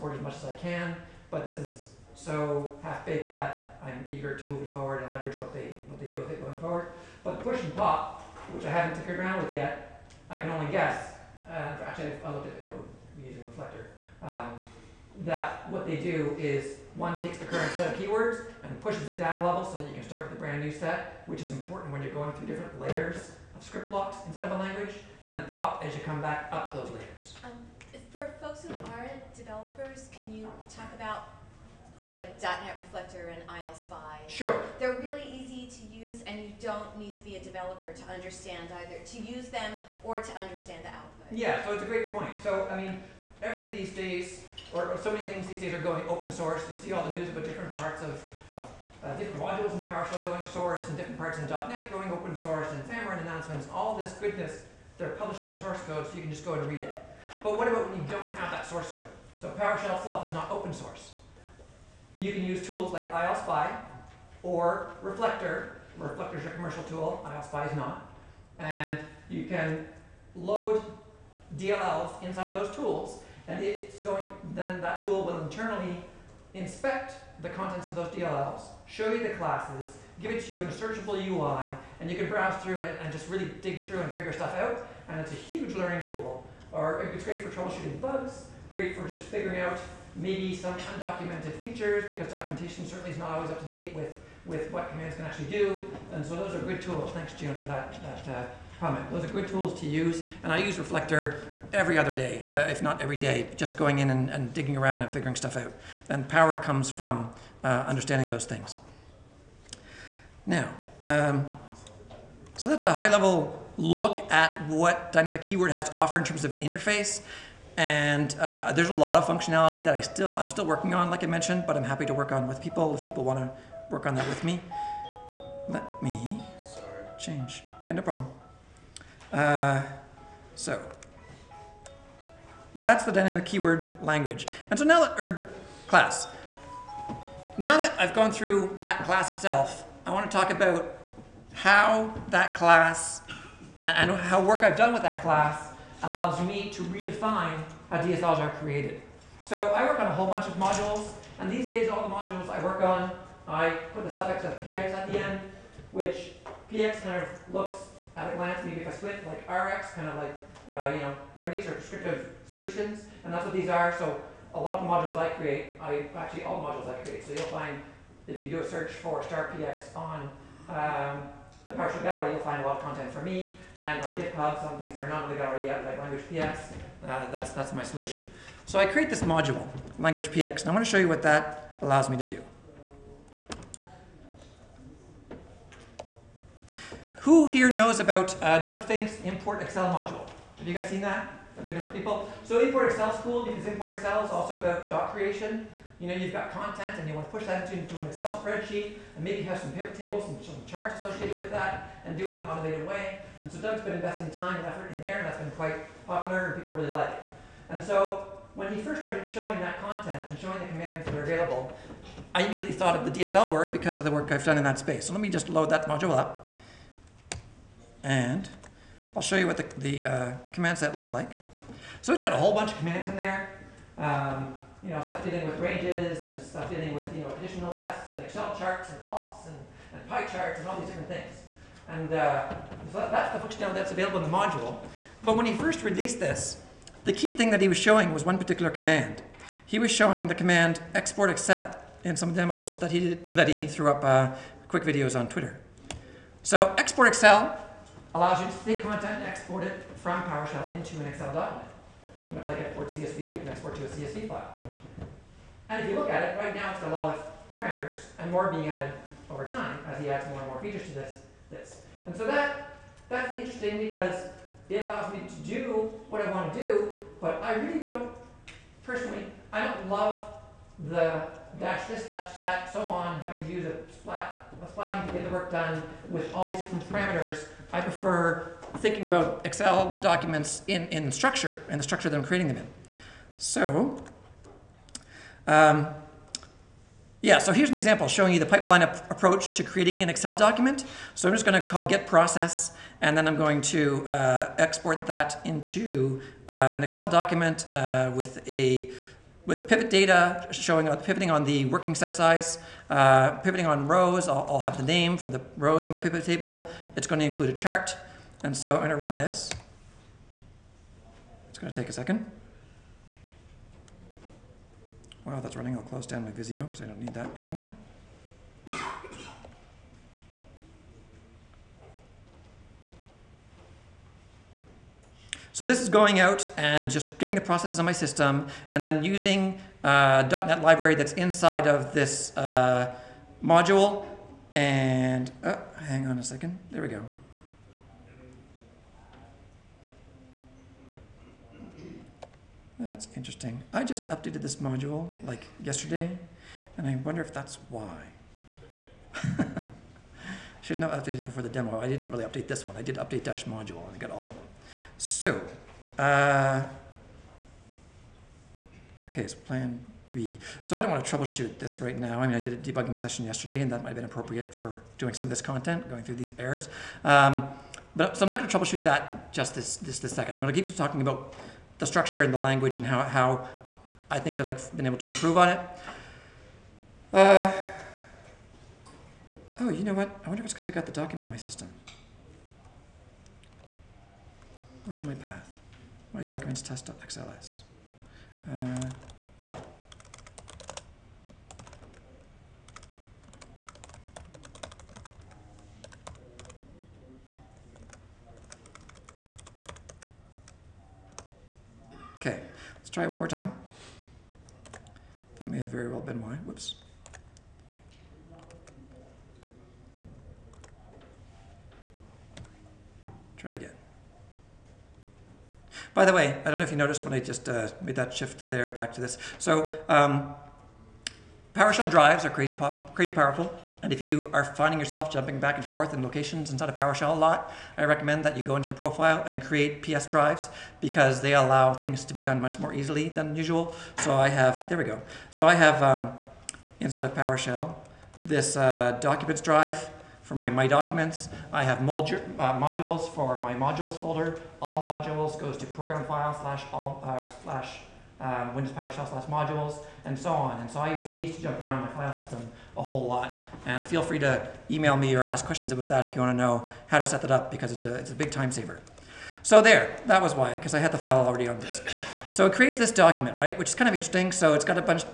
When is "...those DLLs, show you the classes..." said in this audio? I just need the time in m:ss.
1:17.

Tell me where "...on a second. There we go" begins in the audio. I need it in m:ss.
5:36.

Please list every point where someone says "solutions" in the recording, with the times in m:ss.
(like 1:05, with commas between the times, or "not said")
2:42, 2:57.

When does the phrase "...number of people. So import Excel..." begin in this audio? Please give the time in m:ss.
3:11.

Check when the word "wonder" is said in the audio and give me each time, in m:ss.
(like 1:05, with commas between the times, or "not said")
5:46, 6:20.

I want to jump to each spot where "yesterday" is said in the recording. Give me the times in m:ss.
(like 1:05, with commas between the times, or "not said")
5:45, 6:03.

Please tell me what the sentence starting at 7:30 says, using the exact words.
And so I use these to jump around my file system a whole lot.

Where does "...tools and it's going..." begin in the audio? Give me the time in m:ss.
1:12.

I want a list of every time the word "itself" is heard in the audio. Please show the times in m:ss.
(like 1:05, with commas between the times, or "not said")
0:59, 2:19.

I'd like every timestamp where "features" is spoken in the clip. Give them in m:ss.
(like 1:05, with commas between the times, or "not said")
1:31, 4:20.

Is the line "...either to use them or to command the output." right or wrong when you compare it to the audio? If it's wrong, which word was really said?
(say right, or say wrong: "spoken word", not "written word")
wrong: "understand", not "command".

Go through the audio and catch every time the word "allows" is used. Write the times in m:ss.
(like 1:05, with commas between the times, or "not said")
2:26, 3:01, 4:08, 4:24, 7:11.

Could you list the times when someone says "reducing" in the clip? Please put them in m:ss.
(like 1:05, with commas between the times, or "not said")
not said.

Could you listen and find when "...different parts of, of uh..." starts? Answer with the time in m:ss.
0:47.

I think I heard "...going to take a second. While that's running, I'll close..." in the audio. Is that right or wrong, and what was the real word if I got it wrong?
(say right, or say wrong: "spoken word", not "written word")
right.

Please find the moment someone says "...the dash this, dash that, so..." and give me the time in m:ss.
4:30.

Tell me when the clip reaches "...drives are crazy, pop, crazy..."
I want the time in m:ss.
7:01.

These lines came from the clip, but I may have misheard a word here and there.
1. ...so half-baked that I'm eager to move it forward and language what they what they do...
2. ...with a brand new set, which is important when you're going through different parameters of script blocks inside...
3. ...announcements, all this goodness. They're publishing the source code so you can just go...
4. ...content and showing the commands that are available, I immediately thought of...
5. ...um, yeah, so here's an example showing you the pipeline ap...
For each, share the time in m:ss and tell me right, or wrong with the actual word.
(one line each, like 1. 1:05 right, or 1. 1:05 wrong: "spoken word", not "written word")
1. 0:02 wrong: "leverage", not "language"
2. 0:20 wrong: "layers", not "parameters"
3. 0:53 right
4. 3:29 right
5. 4:45 right.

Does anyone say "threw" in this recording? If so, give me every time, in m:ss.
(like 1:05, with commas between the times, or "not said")
4:03.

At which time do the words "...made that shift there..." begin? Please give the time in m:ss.
6:57.